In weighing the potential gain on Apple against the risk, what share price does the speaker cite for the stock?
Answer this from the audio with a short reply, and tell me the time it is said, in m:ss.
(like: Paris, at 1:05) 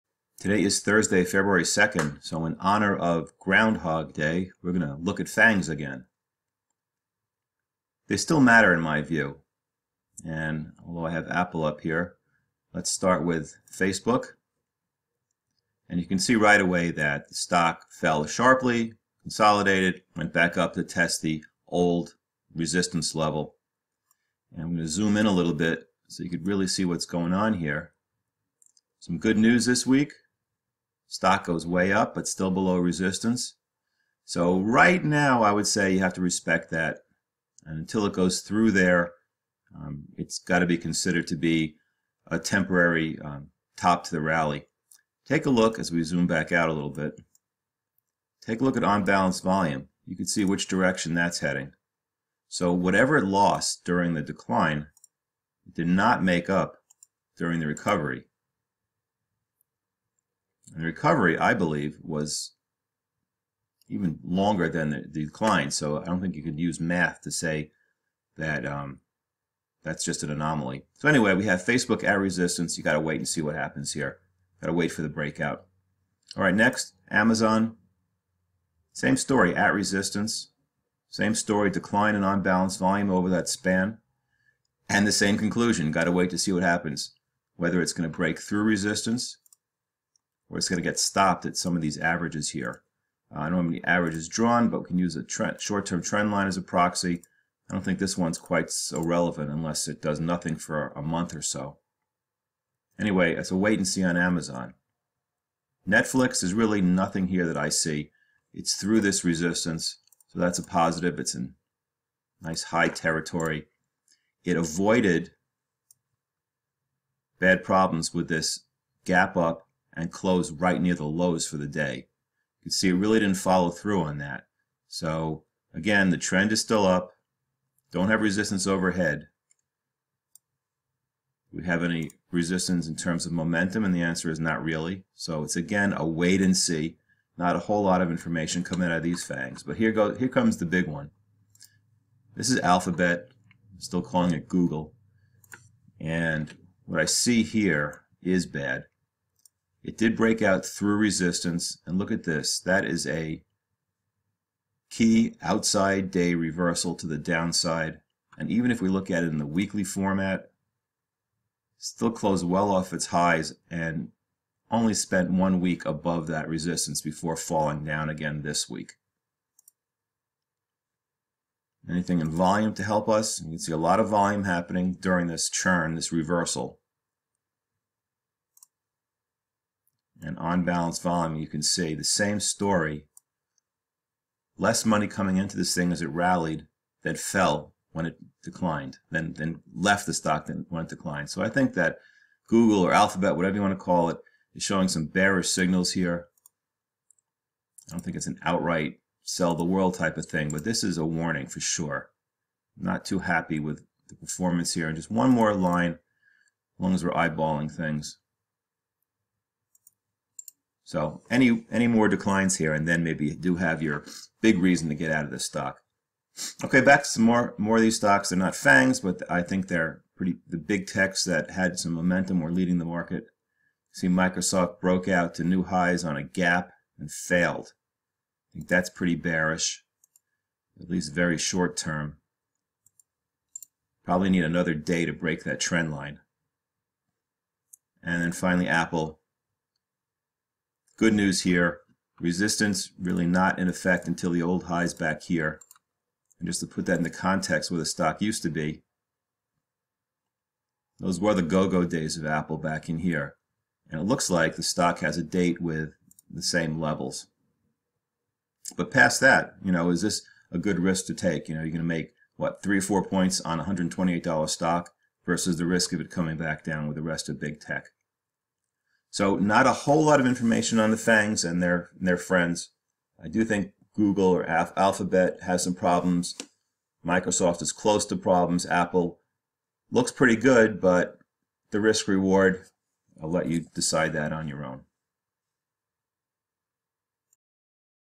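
$128, at 4:23.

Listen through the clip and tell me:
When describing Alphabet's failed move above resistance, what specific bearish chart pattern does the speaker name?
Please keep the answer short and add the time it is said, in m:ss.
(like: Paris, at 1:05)
Key outside day reversal, at 2:34.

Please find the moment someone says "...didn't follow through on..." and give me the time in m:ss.
2:03.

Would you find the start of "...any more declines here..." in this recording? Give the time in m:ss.
3:31.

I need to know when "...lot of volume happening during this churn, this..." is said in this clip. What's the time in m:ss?
2:53.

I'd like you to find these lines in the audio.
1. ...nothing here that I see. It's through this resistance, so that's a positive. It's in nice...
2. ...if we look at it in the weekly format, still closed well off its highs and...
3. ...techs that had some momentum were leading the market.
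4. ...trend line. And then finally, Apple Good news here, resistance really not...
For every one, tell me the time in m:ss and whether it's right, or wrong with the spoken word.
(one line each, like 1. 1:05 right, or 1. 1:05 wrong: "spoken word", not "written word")
1. 1:46 right
2. 2:38 right
3. 3:40 right
4. 3:55 right.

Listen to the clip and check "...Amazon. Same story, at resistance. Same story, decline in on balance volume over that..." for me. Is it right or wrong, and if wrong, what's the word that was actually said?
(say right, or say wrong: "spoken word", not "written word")
right.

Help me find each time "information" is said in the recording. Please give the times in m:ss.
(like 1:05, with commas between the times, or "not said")
2:18, 4:30.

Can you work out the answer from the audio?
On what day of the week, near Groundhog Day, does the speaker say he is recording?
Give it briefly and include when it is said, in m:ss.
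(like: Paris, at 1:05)
Thursday, at 0:00.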